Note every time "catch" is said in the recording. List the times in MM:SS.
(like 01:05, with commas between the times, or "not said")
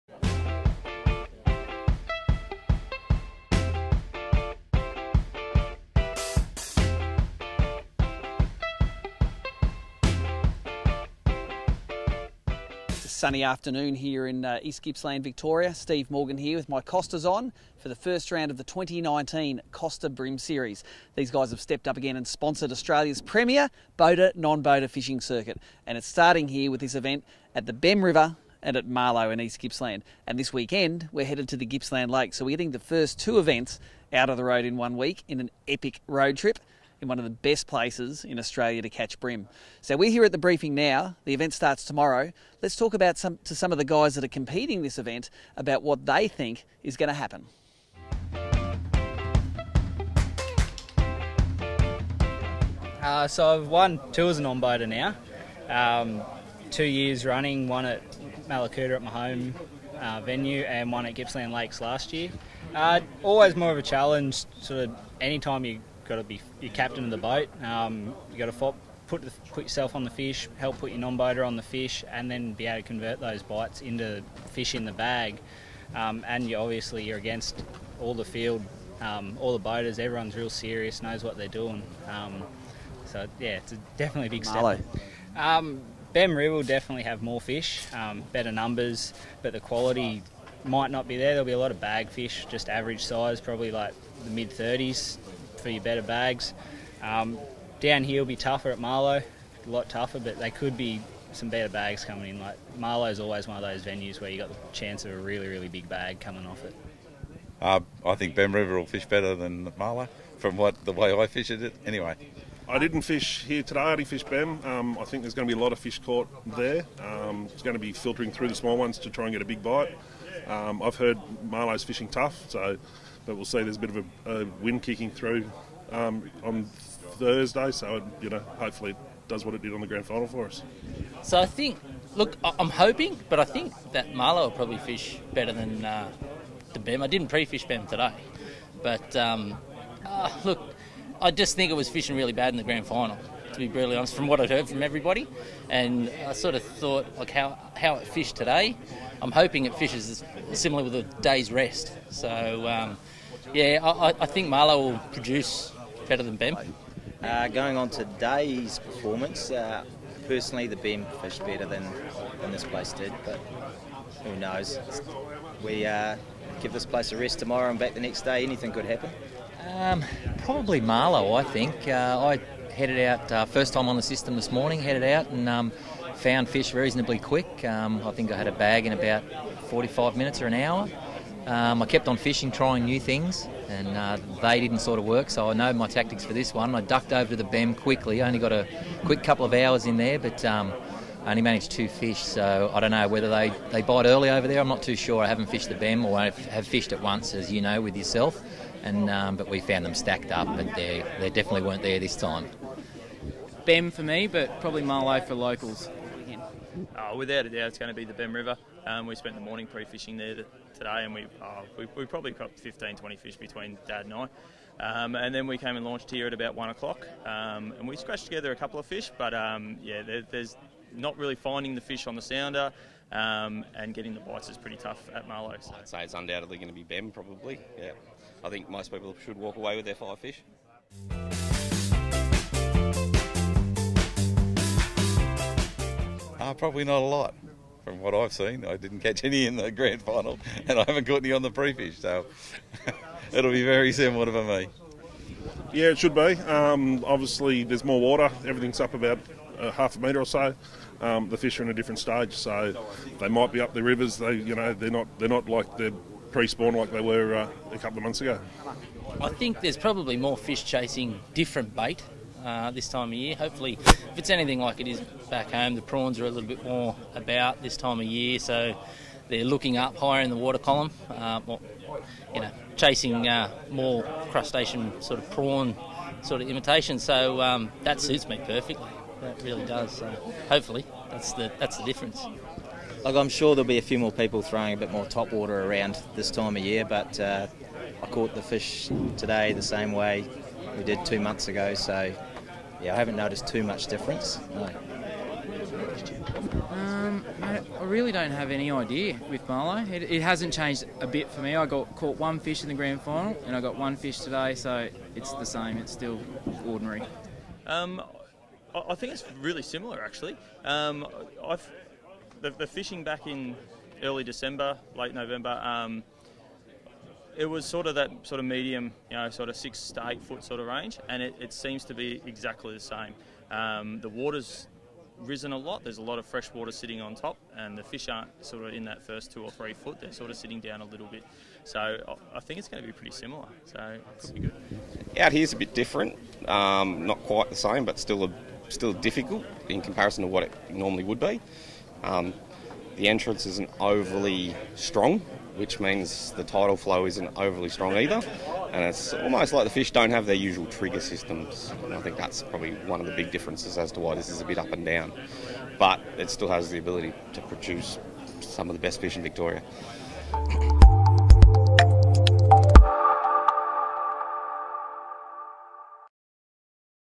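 00:38, 03:58.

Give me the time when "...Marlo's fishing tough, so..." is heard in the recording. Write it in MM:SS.
02:01.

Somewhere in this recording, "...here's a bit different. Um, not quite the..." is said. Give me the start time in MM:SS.
05:35.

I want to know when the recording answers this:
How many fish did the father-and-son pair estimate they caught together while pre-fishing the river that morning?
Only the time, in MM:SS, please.
03:32.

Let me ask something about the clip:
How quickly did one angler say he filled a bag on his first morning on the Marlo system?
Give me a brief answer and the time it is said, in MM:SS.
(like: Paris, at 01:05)
about 45 minutes, at 02:58.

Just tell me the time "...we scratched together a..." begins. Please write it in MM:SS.
03:37.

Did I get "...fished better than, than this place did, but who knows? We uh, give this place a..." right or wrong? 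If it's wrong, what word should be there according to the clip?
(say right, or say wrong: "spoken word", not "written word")
right.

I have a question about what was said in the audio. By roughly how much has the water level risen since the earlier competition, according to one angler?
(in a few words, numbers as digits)
half a metre.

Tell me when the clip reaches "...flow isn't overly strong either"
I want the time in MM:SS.
05:46.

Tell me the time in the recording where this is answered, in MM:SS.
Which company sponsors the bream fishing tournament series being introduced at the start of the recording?
00:19.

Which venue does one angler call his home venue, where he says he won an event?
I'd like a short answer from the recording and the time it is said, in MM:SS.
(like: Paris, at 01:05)
Mallacoota, at 00:58.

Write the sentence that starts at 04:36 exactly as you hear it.
So um, that suits me perfectly.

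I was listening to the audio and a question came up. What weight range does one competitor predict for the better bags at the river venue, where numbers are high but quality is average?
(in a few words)
mid 30s.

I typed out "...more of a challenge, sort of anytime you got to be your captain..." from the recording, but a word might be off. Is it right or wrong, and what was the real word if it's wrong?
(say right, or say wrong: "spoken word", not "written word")
right.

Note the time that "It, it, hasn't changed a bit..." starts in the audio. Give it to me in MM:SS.
04:59.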